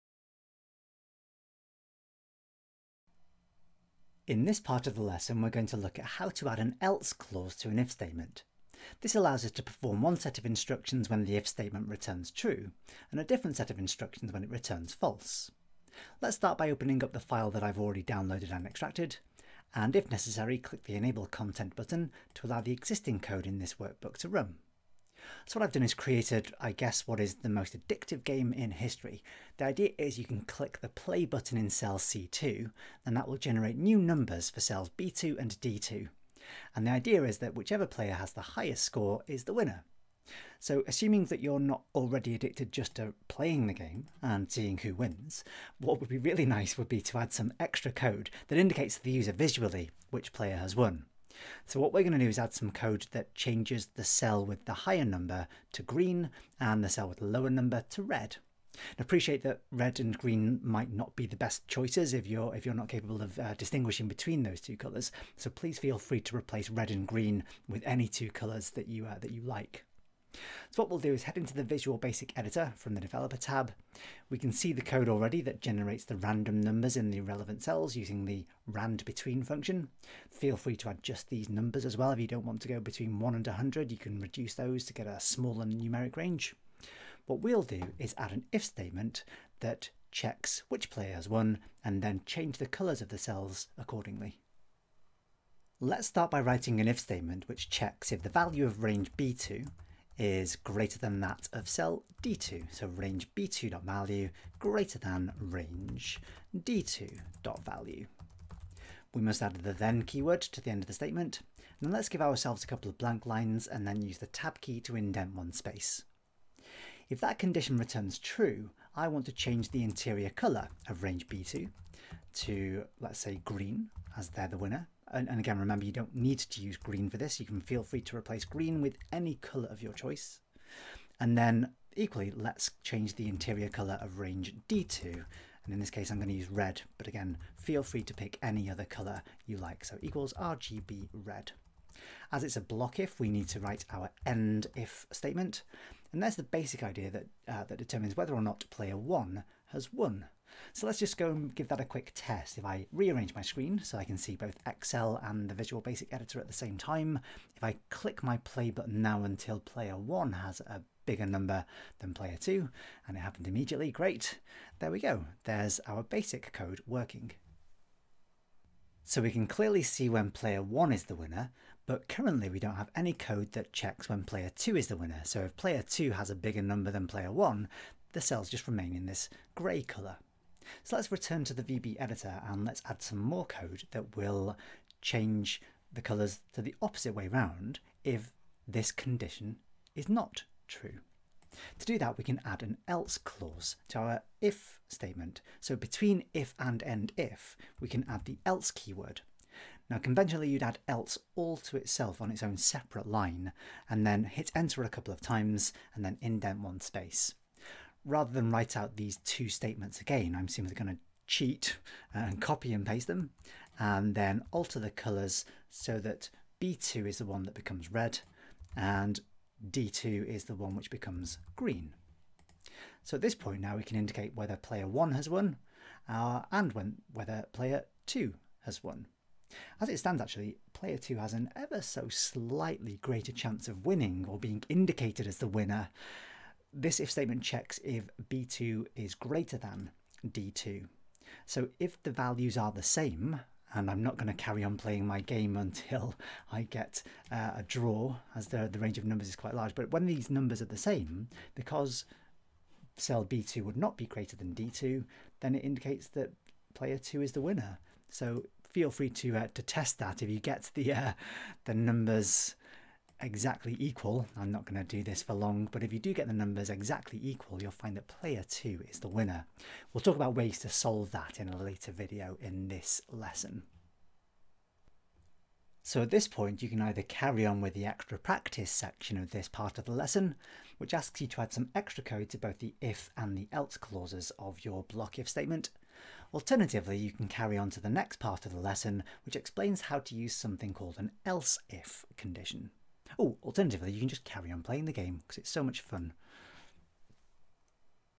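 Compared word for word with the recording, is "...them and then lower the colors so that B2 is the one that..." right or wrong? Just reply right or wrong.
wrong.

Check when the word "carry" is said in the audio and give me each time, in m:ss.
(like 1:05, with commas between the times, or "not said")
4:04, 4:37, 4:47, 4:54.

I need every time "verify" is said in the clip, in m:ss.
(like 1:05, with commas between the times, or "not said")
not said.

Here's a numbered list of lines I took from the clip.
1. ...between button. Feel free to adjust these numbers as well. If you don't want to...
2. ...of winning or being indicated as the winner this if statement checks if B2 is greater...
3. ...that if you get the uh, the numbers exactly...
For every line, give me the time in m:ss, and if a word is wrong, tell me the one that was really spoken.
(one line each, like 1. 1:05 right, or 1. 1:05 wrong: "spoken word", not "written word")
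1. 1:19 wrong: "function", not "button"
2. 3:53 right
3. 4:19 right.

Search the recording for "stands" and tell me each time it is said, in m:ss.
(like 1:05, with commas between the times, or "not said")
3:49.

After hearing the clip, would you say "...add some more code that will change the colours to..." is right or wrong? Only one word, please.
right.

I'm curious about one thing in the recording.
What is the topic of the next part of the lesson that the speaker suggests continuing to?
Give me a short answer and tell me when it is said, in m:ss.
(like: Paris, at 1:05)
Else if condition, at 4:51.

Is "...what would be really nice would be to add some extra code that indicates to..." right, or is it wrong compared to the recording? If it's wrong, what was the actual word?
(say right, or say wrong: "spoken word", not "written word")
right.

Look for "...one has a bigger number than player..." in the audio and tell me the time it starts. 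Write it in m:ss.
2:39.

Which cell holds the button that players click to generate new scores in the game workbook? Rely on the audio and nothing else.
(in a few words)
C2.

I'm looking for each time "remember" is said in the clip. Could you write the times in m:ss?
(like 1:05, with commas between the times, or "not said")
2:05.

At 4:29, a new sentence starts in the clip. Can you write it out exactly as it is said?
We'll talk about ways to solve that in a later video in this lesson.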